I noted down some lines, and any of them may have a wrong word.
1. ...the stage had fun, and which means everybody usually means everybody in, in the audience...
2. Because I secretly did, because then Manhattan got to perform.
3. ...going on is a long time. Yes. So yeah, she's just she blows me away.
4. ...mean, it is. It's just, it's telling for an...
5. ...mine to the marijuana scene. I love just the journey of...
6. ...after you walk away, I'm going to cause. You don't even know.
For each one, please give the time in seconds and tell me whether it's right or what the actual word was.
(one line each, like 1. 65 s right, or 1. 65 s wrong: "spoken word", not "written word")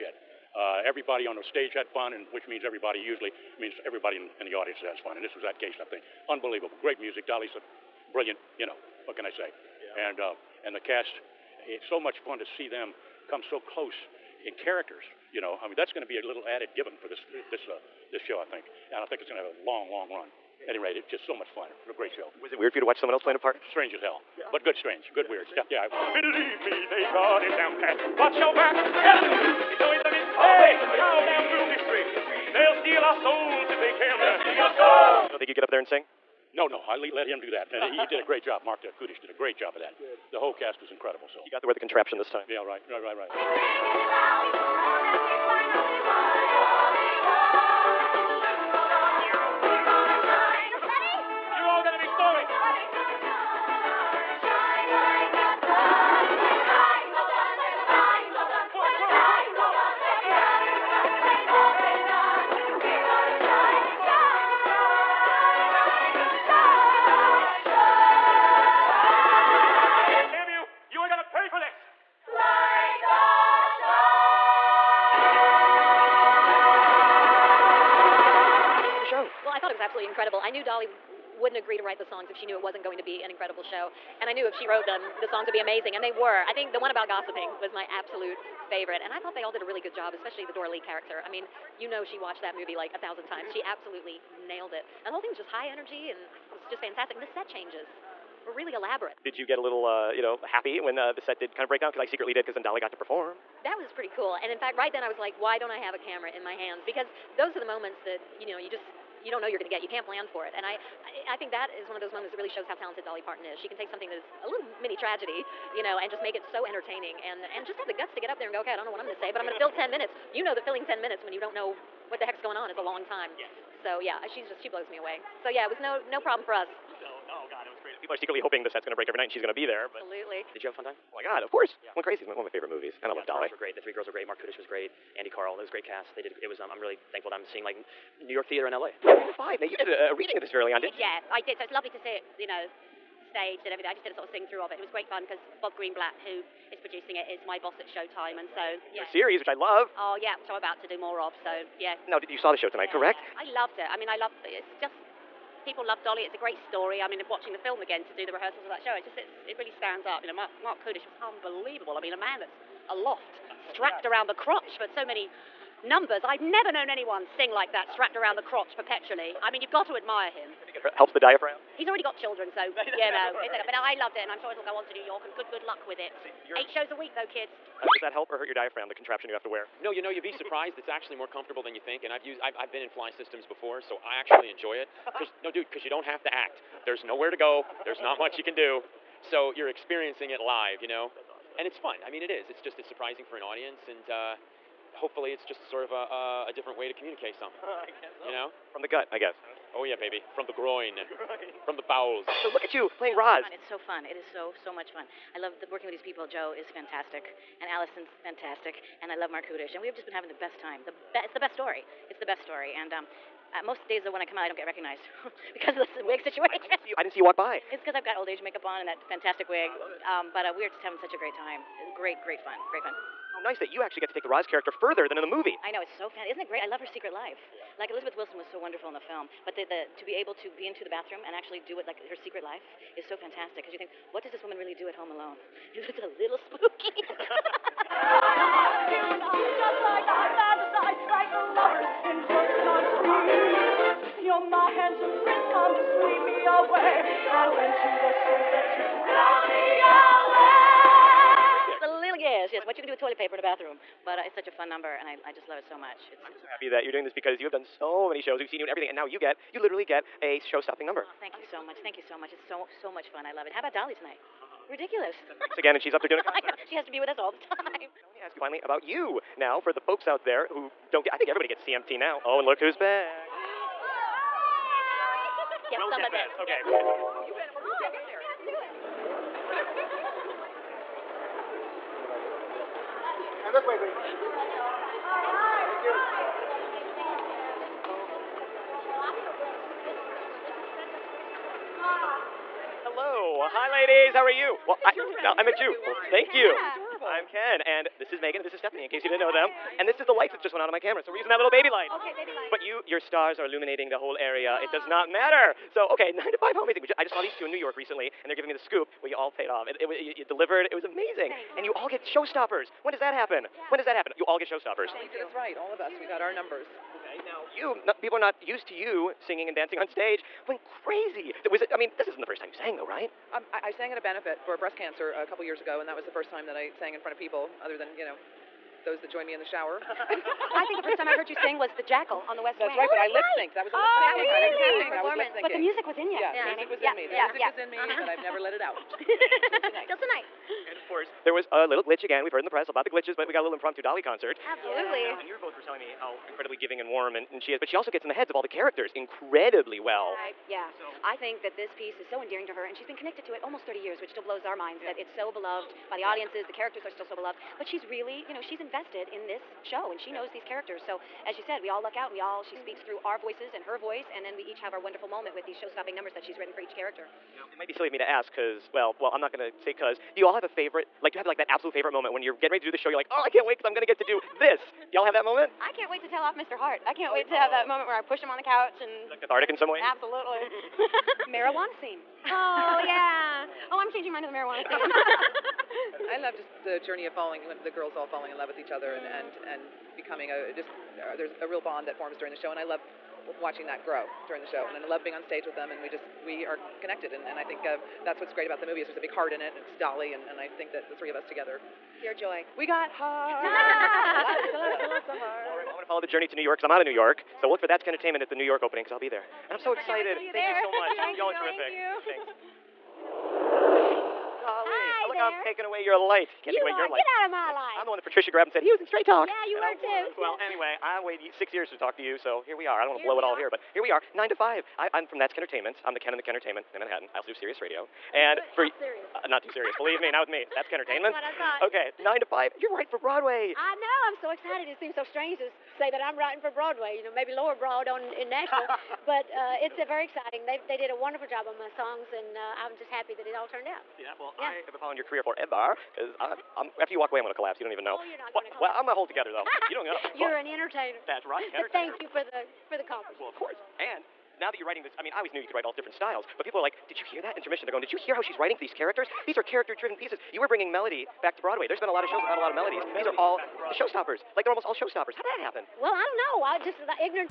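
1. 1 s right
2. 101 s wrong: "Dolly", not "Manhattan"
3. 122 s right
4. 192 s wrong: "surprising", not "telling"
5. 384 s right
6. 446 s wrong: "collapse", not "cause".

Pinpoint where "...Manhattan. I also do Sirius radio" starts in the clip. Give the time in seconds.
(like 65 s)
426 s.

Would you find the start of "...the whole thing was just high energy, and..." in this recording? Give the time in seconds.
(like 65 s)
95 s.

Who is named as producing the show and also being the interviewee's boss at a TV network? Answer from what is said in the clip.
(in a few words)
Bob Greenblatt.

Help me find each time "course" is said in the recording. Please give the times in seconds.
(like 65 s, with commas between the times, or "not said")
131 s, 340 s, 453 s.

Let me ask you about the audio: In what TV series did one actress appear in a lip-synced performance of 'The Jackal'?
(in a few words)
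The West Wing.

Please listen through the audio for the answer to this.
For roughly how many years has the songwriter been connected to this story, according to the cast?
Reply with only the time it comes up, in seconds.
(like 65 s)
353 s.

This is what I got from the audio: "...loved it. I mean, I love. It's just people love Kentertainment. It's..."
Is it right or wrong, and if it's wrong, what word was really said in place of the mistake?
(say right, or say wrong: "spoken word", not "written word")
wrong: "Dolly", not "Kentertainment".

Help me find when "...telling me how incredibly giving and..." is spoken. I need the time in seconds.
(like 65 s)
345 s.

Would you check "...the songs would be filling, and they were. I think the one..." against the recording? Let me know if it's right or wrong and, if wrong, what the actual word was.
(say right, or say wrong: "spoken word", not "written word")
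wrong: "amazing", not "filling".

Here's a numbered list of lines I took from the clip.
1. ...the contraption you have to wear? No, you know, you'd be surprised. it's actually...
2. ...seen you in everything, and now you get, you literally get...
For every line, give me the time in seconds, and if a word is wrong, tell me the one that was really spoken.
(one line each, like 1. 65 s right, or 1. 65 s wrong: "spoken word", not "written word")
1. 178 s right
2. 258 s right.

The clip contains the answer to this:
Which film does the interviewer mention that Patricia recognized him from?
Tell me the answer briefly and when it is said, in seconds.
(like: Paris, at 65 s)
Straight Talk, at 418 s.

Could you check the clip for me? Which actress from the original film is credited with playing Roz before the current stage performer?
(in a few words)
Elizabeth Wilson.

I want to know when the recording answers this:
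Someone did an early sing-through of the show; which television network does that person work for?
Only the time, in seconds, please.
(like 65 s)
147 s.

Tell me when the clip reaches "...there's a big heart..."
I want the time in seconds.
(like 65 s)
398 s.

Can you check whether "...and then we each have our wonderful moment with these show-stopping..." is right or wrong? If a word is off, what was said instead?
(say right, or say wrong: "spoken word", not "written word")
right.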